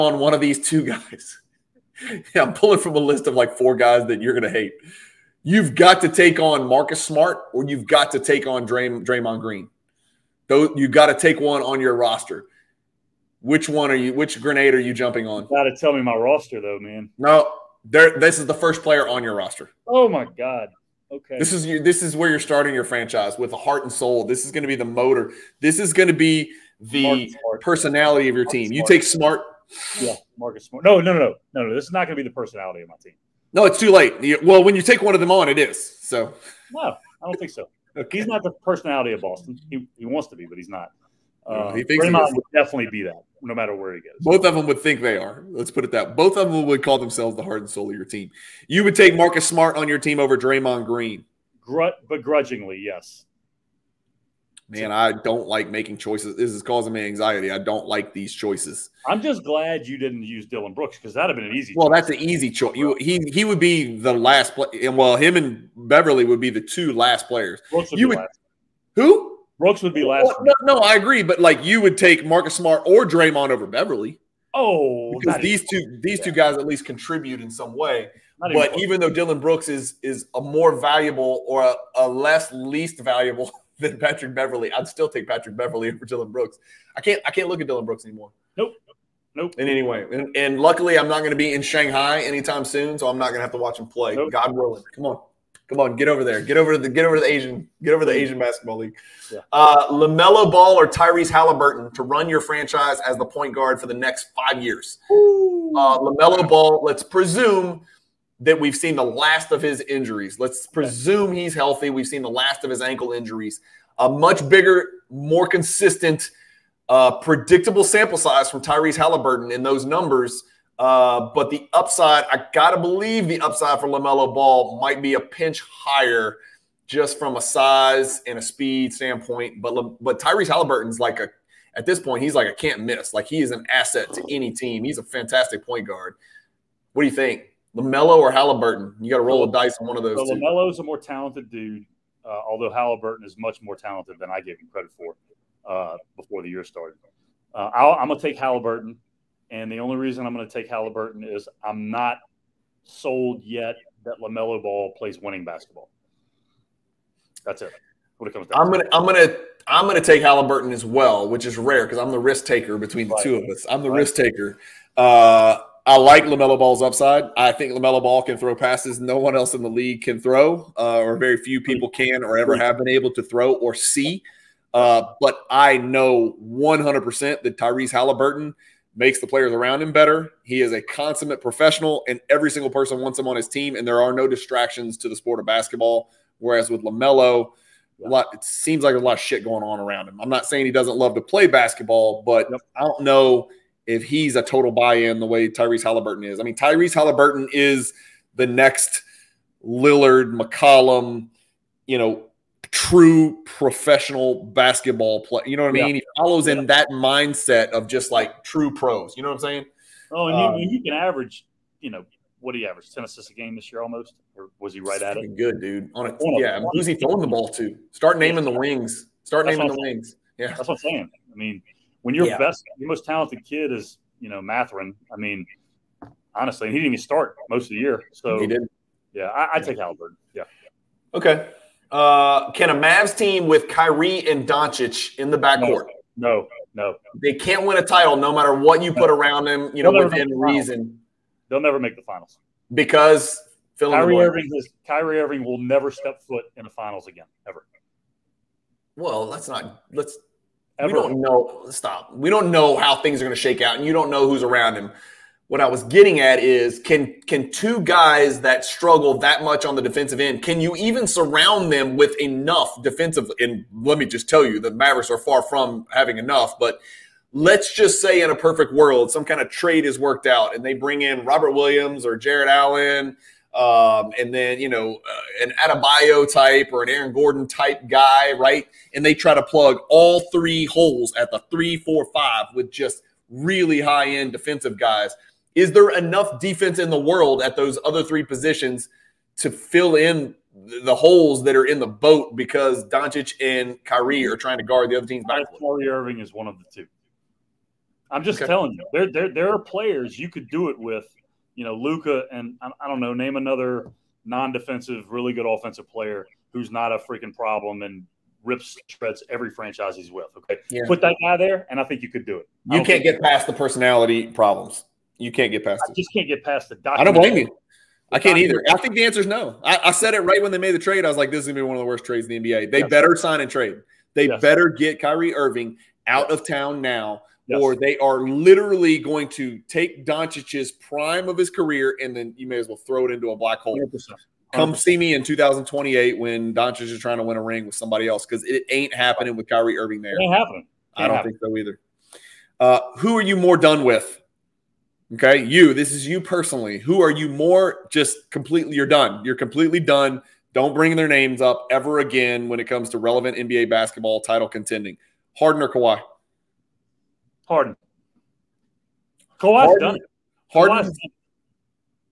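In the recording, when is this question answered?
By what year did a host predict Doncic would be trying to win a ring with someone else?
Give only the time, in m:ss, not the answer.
5:35.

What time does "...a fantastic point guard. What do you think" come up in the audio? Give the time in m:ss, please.
2:14.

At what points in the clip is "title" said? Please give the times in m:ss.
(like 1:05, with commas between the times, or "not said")
3:57, 5:54.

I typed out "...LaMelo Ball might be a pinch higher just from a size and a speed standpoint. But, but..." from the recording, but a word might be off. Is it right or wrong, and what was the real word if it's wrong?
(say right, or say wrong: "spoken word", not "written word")
right.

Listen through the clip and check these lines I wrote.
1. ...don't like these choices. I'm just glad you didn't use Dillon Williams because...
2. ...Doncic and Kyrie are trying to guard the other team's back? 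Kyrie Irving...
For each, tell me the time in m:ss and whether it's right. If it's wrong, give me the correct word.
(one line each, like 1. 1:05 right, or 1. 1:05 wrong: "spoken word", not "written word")
1. 0:57 wrong: "Brooks", not "Williams"
2. 4:52 right.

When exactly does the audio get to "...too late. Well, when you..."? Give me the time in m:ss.
0:33.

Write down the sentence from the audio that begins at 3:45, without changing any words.
I mean, honestly, he didn't even start most of the year.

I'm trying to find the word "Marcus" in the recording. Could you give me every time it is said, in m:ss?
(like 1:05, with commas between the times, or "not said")
0:06, 0:30, 0:49, 1:12.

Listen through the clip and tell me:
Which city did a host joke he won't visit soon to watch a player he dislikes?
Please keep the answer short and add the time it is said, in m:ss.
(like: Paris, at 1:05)
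Shanghai, at 1:31.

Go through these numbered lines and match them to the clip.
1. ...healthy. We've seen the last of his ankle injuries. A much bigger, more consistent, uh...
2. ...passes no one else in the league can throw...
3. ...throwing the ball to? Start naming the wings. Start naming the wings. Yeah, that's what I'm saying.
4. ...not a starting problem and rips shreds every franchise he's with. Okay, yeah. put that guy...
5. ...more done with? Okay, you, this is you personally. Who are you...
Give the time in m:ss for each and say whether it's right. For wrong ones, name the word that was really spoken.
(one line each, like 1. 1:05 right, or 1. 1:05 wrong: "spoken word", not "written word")
1. 1:51 right
2. 2:48 right
3. 3:36 right
4. 5:06 wrong: "freaking", not "starting"
5. 5:43 right.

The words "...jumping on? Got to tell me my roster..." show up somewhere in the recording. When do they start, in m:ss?
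0:14.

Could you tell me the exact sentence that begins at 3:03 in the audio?
And there are no distractions to the sport of basketball.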